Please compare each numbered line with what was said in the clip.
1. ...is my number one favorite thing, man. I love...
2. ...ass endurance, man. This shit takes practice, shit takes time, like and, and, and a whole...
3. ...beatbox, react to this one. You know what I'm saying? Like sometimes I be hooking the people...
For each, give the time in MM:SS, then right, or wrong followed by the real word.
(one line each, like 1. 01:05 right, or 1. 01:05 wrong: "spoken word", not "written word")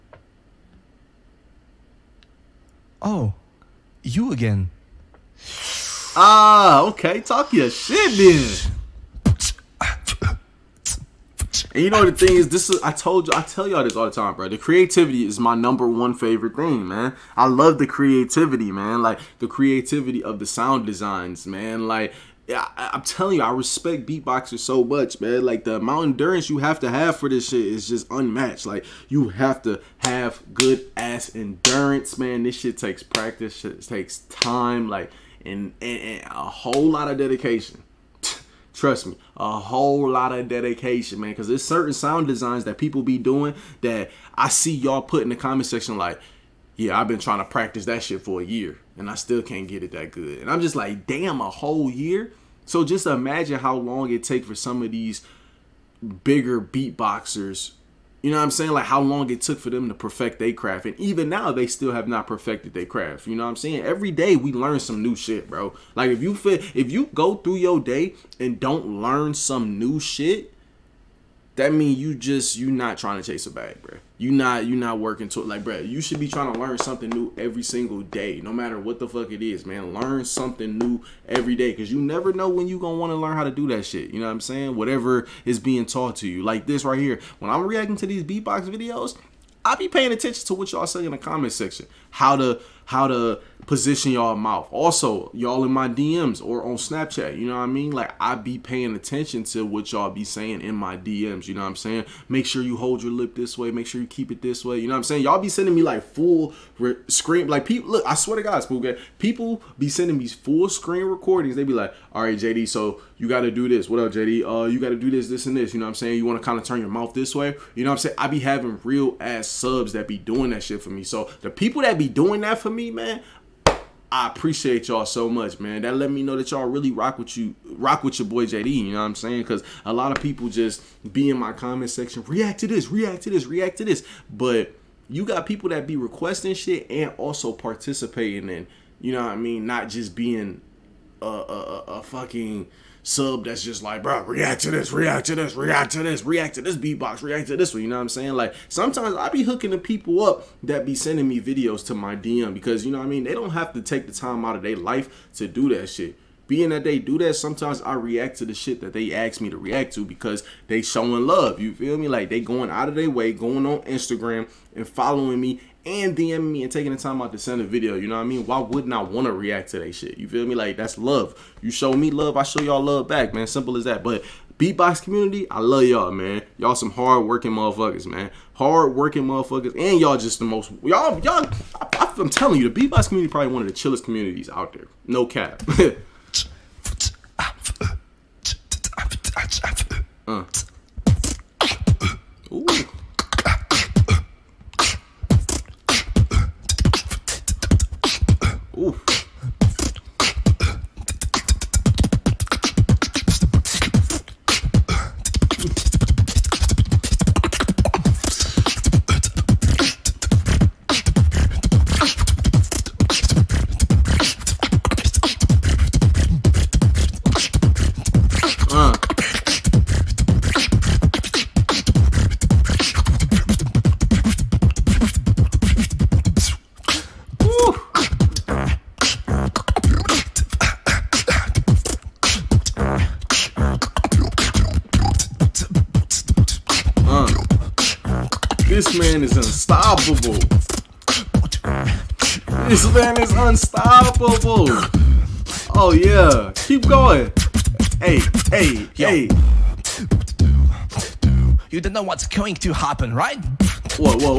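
1. 00:15 right
2. 00:30 right
3. 02:26 right.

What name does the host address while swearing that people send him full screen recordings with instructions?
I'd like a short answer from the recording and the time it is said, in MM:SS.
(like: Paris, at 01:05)
Spook, at 01:48.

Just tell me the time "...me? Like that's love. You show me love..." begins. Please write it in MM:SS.
02:50.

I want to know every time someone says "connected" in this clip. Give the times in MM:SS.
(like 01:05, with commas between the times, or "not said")
not said.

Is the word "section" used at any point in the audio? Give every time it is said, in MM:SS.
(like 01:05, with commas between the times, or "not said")
00:45, 01:31, 02:11.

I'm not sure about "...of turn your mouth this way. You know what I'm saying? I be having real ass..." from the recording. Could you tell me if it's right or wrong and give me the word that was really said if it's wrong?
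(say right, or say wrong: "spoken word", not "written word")
right.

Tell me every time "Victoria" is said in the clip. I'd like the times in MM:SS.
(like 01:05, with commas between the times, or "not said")
not said.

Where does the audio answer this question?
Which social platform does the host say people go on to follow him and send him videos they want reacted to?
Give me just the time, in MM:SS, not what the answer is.
02:43.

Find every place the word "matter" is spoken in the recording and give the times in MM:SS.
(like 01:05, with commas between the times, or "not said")
01:18.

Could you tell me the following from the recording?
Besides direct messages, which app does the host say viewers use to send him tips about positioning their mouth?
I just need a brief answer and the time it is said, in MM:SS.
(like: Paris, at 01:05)
Snapchat, at 01:36.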